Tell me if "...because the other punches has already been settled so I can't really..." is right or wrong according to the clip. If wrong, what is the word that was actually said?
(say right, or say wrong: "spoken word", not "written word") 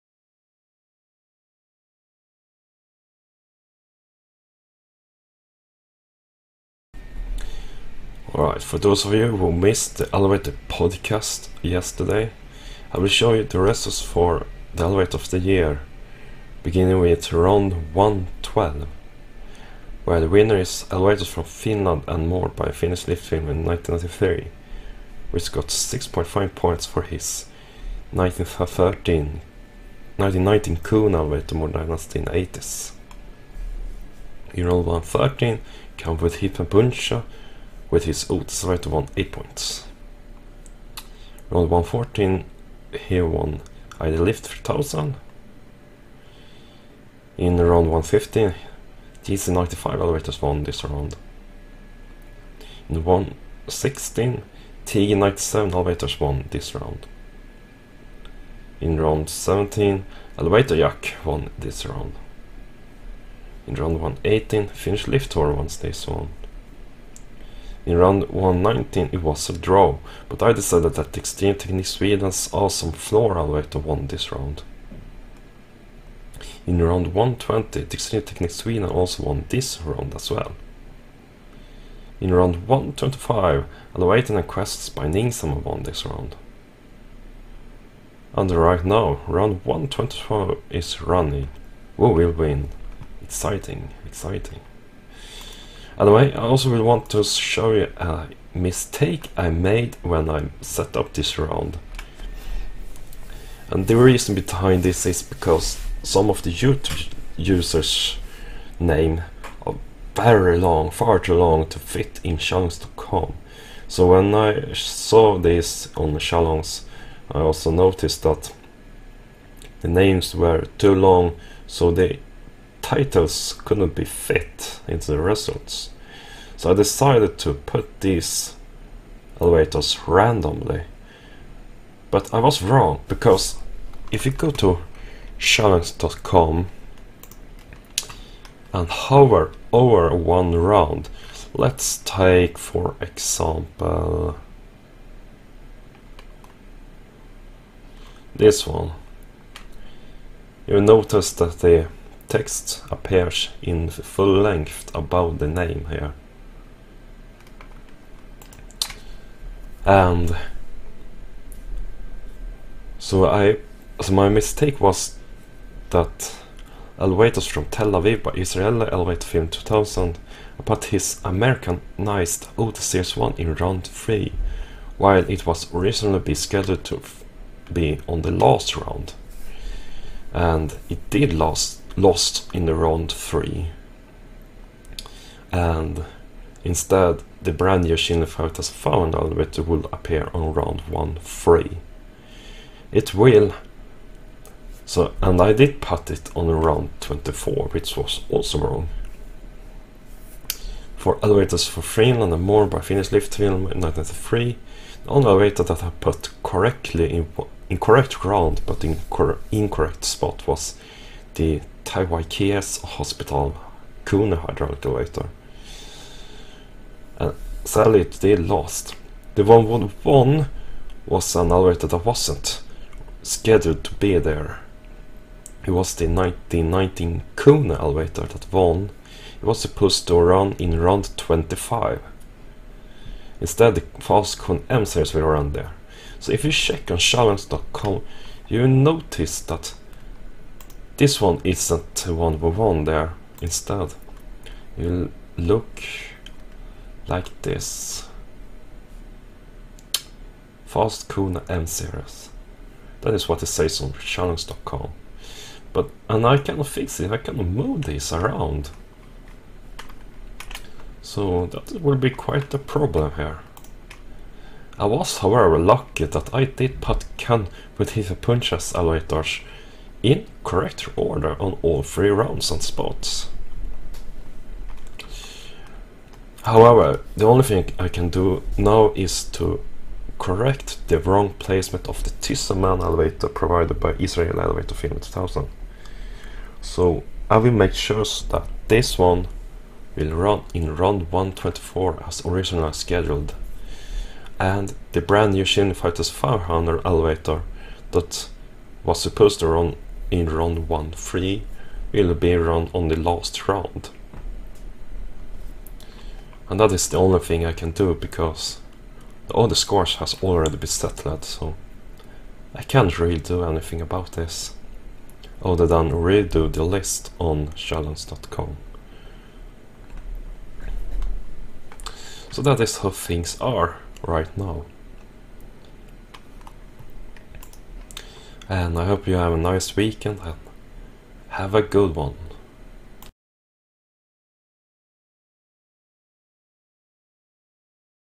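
wrong: "scores", not "punches".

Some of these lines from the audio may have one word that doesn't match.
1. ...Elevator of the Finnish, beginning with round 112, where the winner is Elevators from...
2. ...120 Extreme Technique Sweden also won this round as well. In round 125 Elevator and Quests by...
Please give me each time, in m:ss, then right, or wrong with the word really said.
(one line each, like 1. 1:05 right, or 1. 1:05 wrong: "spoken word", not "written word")
1. 0:14 wrong: "Year", not "Finnish"
2. 1:17 right.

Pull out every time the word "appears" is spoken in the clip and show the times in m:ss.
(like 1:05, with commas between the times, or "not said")
2:32, 3:09.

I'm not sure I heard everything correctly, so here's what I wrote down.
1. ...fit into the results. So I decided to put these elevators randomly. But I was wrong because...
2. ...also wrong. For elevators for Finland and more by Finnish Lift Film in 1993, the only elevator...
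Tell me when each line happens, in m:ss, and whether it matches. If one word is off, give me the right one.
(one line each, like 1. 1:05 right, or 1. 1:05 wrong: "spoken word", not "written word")
1. 2:04 right
2. 3:18 right.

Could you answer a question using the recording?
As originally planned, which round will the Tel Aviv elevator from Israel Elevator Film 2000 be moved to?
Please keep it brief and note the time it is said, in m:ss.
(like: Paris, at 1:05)
124, at 4:50.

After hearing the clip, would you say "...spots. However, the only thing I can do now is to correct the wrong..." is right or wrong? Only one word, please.
right.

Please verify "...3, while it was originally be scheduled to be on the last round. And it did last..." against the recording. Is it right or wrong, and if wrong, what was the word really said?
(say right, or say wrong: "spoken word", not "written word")
right.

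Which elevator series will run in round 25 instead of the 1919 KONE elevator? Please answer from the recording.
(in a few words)
Falcon M series.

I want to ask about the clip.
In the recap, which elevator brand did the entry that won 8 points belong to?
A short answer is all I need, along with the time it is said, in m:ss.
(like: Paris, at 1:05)
Otis, at 0:38.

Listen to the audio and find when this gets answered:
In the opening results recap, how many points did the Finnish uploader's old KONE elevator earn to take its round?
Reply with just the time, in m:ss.
0:25.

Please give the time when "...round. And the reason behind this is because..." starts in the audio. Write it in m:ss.
1:41.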